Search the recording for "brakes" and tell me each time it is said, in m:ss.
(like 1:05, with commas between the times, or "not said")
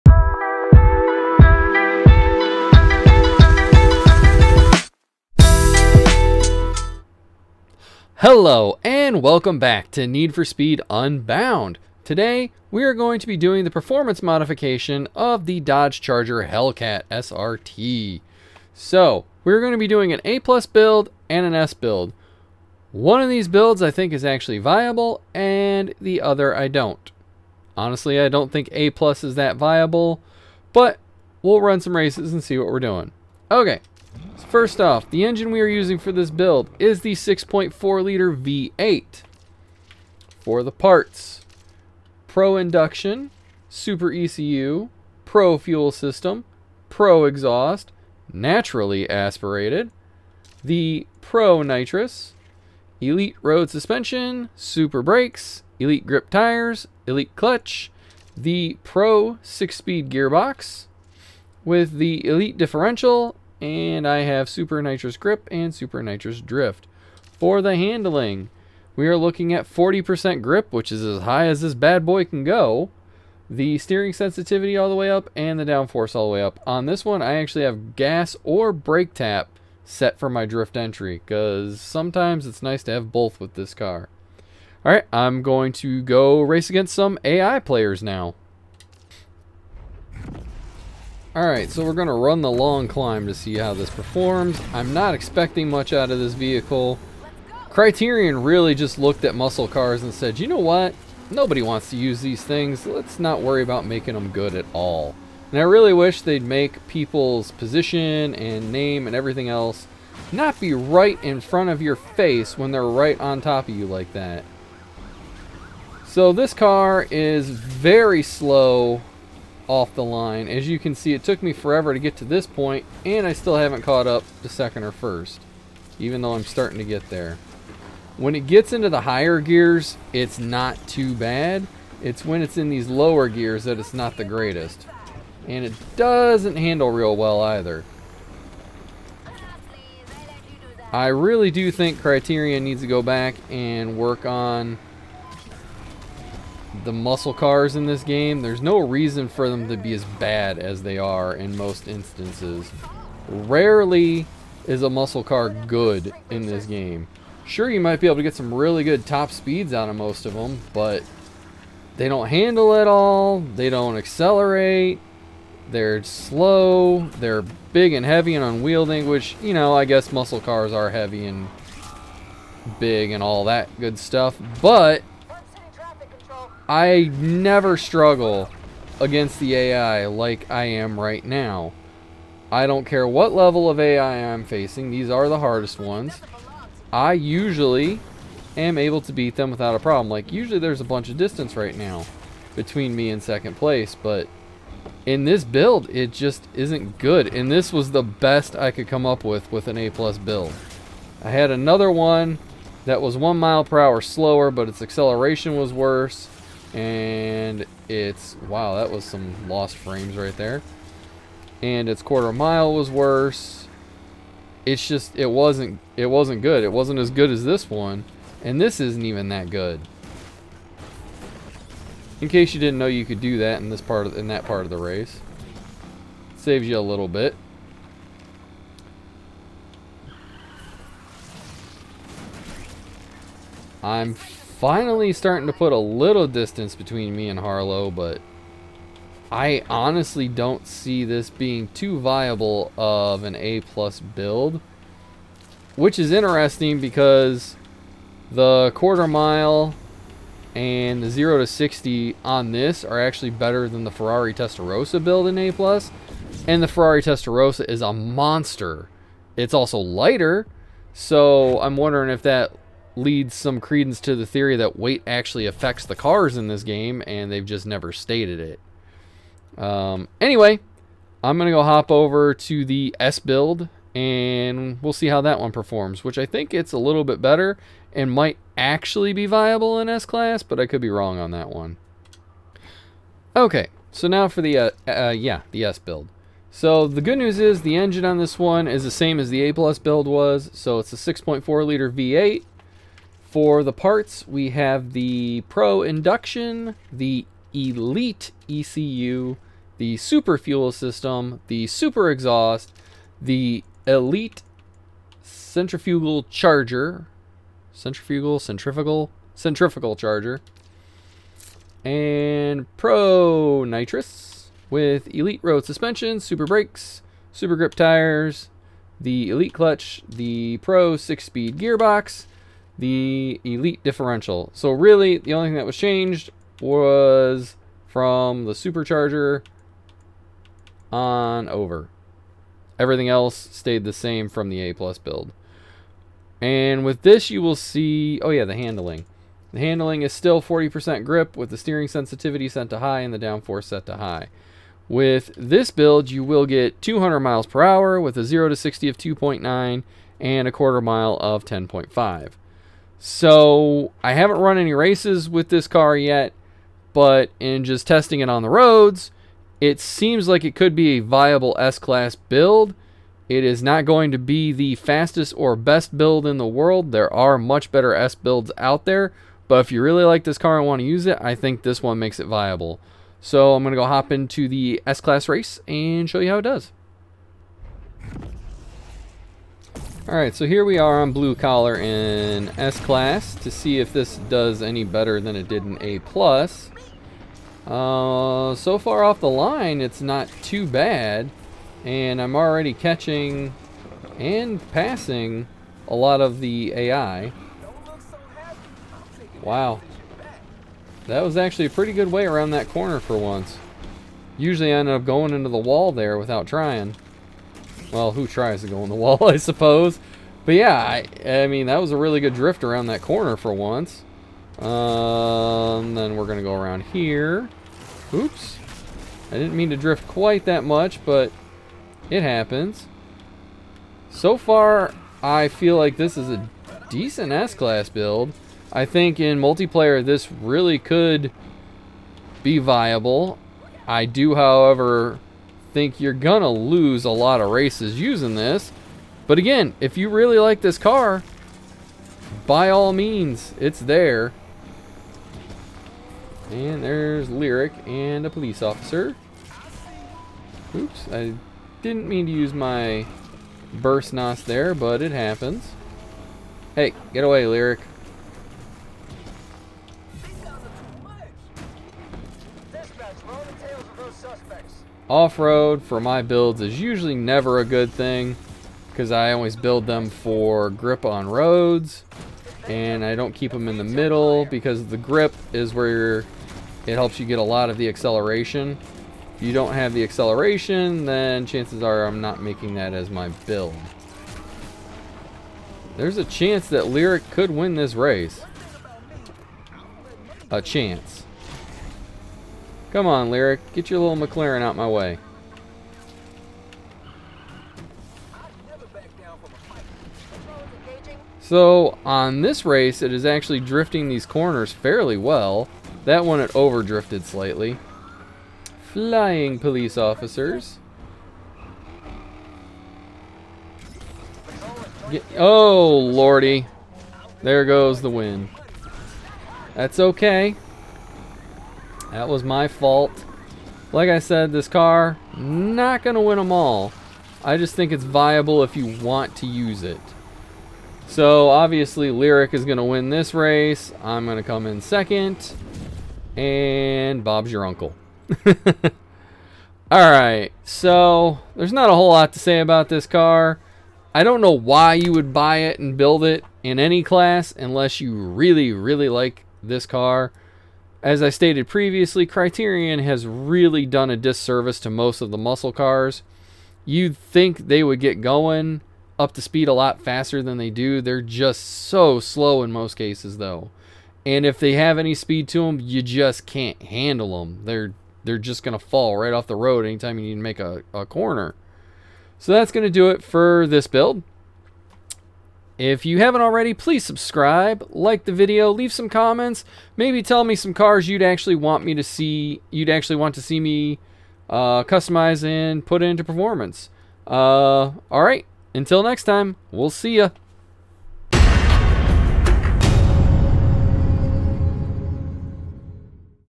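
0:55, 1:18, 5:16.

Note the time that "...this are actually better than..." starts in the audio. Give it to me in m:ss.
4:12.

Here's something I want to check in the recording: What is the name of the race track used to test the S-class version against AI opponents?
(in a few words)
Blue Collar.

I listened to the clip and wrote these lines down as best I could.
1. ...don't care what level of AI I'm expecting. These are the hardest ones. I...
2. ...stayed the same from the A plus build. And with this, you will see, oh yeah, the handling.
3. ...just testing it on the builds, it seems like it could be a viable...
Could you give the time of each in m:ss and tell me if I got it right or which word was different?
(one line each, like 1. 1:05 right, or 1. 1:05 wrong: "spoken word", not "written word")
1. 3:02 wrong: "facing", not "expecting"
2. 5:33 right
3. 5:57 wrong: "roads", not "builds".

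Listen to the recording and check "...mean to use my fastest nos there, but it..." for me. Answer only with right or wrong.
wrong.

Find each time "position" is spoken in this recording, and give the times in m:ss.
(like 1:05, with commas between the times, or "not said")
1:47.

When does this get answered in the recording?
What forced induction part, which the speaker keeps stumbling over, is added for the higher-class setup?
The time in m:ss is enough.
5:03.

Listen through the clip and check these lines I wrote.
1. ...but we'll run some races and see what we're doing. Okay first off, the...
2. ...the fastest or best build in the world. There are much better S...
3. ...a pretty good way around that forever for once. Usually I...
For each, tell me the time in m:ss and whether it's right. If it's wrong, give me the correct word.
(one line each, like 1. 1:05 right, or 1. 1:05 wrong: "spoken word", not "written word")
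1. 0:30 right
2. 6:04 right
3. 6:41 wrong: "corner", not "forever".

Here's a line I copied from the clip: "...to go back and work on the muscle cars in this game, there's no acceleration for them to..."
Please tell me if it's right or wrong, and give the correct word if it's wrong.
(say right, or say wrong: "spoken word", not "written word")
wrong: "reason", not "acceleration".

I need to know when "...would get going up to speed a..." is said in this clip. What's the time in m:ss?
9:17.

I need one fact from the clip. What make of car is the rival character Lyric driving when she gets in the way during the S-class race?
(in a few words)
McLaren.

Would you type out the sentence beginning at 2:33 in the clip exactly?
Rarely is a muscle car good in this game.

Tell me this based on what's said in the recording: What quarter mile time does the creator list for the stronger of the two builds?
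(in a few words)
10.5.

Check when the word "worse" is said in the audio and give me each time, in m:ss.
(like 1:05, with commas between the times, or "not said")
3:25, 3:32.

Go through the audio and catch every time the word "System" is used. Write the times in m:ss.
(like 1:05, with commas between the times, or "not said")
0:45, 5:00.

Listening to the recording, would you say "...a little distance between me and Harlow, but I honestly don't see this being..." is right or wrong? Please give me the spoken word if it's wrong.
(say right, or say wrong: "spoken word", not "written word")
right.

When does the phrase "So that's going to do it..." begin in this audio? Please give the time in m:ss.
9:32.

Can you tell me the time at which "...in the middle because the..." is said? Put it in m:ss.
7:53.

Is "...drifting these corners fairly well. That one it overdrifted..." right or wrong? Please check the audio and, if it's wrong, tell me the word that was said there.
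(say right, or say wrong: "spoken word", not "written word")
right.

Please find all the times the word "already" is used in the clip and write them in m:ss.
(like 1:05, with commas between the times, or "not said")
6:32, 9:36.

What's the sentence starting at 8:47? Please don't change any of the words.
I just think it's viable if you want to use it.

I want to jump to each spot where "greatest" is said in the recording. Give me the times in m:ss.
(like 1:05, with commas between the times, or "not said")
2:14.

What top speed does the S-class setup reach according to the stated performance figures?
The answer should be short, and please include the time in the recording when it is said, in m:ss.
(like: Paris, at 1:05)
200 mph, at 5:46.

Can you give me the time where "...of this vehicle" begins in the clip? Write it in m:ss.
1:36.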